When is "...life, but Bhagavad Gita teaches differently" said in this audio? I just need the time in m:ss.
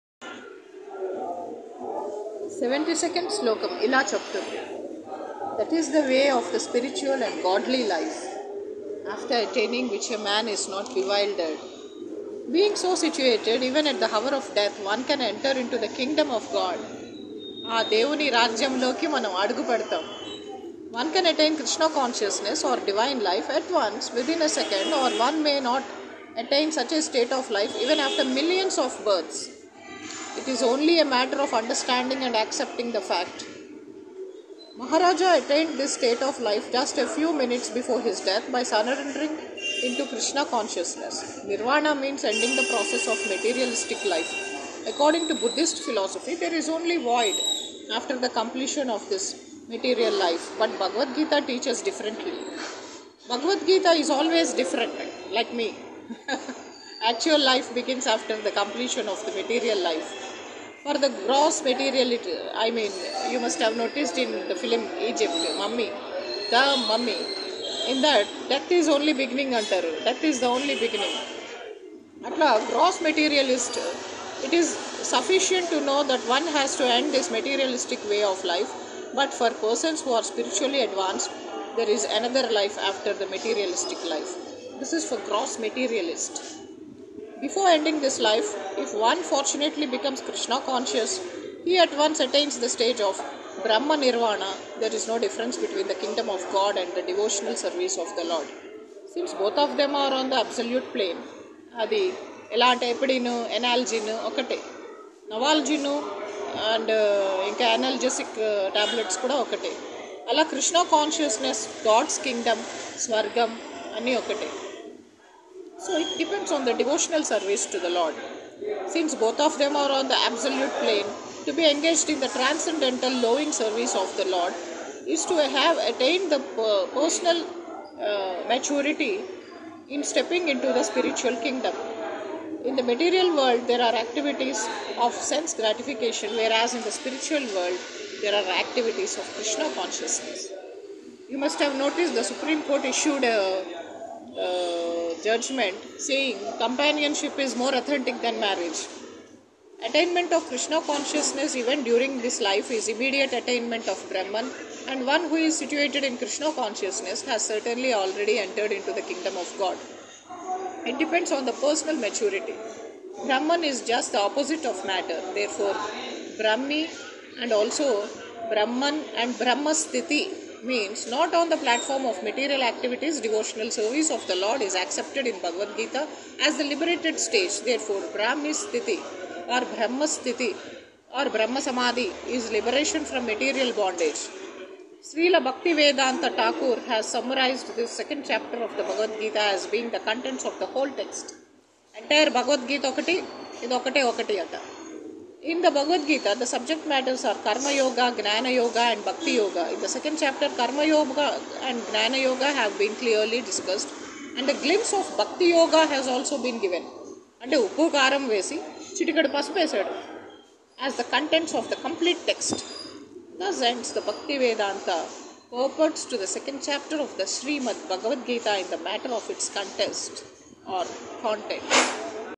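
0:50.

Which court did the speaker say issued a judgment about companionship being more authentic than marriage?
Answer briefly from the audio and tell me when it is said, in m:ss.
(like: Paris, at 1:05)
Supreme Court, at 2:22.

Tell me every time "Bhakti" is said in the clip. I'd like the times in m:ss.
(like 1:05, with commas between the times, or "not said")
3:19, 3:25.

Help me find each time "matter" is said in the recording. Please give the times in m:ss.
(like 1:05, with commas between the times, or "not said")
0:31, 2:44, 3:16, 3:38.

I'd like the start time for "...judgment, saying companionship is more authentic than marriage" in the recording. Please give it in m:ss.
2:25.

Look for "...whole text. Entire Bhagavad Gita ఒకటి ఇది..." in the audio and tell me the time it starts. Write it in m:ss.
3:10.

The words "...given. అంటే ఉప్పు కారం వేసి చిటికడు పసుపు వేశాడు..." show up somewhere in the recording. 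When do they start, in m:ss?
3:26.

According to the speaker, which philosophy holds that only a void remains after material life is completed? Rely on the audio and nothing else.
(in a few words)
Buddhist philosophy.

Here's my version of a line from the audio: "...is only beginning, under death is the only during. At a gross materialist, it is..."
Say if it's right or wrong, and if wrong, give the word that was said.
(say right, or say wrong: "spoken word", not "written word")
wrong: "beginning", not "during".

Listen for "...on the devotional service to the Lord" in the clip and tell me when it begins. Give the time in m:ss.
1:56.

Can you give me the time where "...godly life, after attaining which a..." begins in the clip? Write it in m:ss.
0:07.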